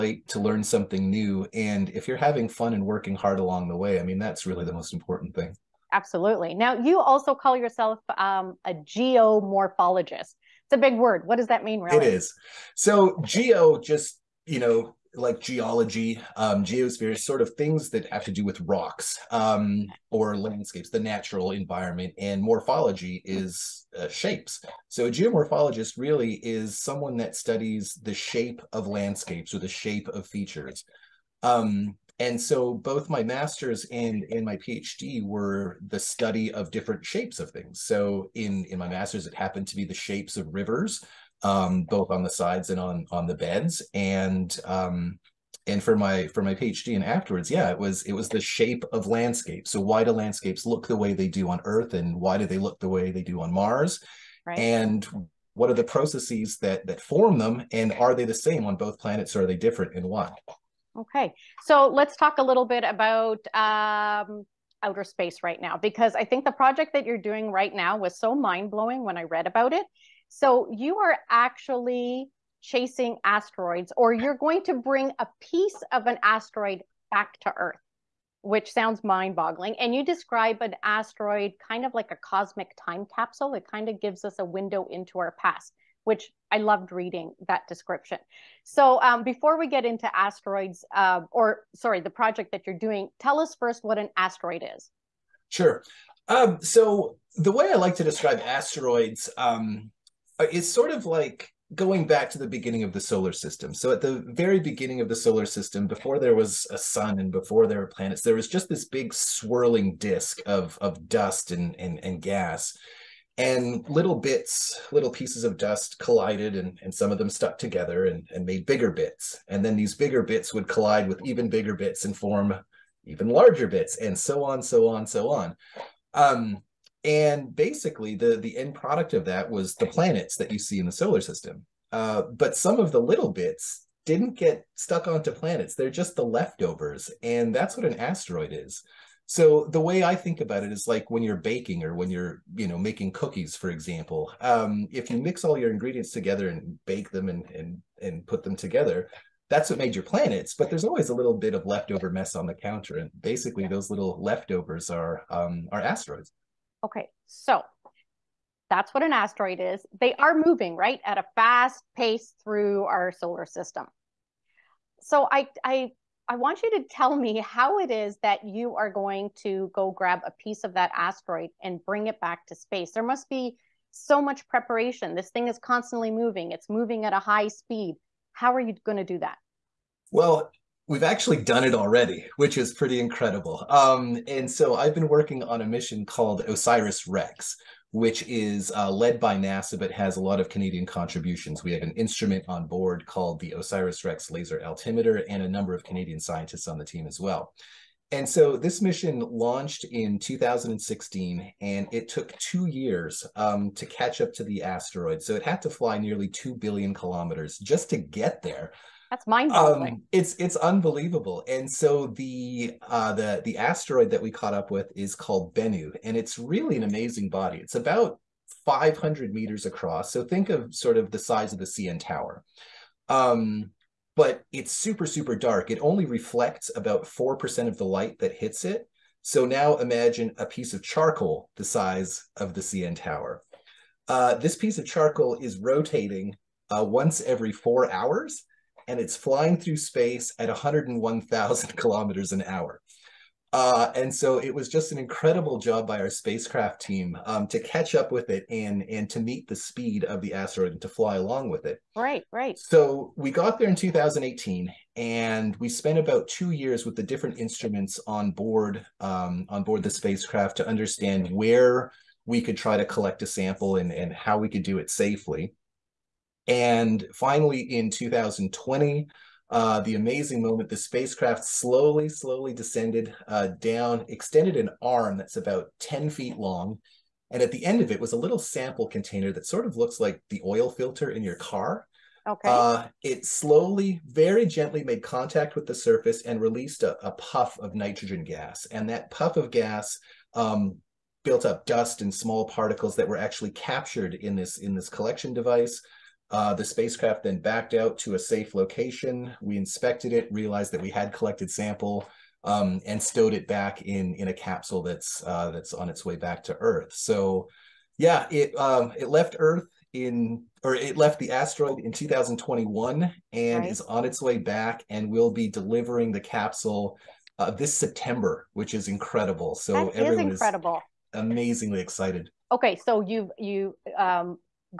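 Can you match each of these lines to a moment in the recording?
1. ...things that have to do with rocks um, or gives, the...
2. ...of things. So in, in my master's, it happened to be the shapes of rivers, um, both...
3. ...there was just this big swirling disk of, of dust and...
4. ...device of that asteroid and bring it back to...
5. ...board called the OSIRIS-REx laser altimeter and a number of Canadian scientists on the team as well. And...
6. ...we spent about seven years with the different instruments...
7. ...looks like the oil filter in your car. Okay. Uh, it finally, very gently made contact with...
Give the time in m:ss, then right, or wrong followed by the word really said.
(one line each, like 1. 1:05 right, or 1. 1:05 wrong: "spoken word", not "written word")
1. 0:17 wrong: "landscapes", not "gives"
2. 0:37 right
3. 1:48 right
4. 2:50 wrong: "piece", not "device"
5. 3:12 right
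6. 4:15 wrong: "two", not "seven"
7. 4:39 wrong: "slowly", not "finally".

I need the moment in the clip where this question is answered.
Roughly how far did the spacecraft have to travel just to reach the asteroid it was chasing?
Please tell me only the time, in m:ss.
3:25.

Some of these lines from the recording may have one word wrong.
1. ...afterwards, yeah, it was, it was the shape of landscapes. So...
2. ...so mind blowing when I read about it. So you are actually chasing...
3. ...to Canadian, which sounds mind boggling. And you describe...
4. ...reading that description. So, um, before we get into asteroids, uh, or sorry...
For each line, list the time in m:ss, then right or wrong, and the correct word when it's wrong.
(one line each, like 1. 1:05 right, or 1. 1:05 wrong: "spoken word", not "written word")
1. 0:47 right
2. 1:08 right
3. 1:17 wrong: "Earth", not "Canadian"
4. 1:26 right.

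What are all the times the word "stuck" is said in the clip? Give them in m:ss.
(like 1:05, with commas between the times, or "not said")
1:57, 2:14.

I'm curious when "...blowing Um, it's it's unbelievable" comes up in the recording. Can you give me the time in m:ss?
3:29.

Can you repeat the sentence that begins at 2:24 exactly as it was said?
Um, if you mix all your ingredients together and bake them and and and put them together, that's what made your planets.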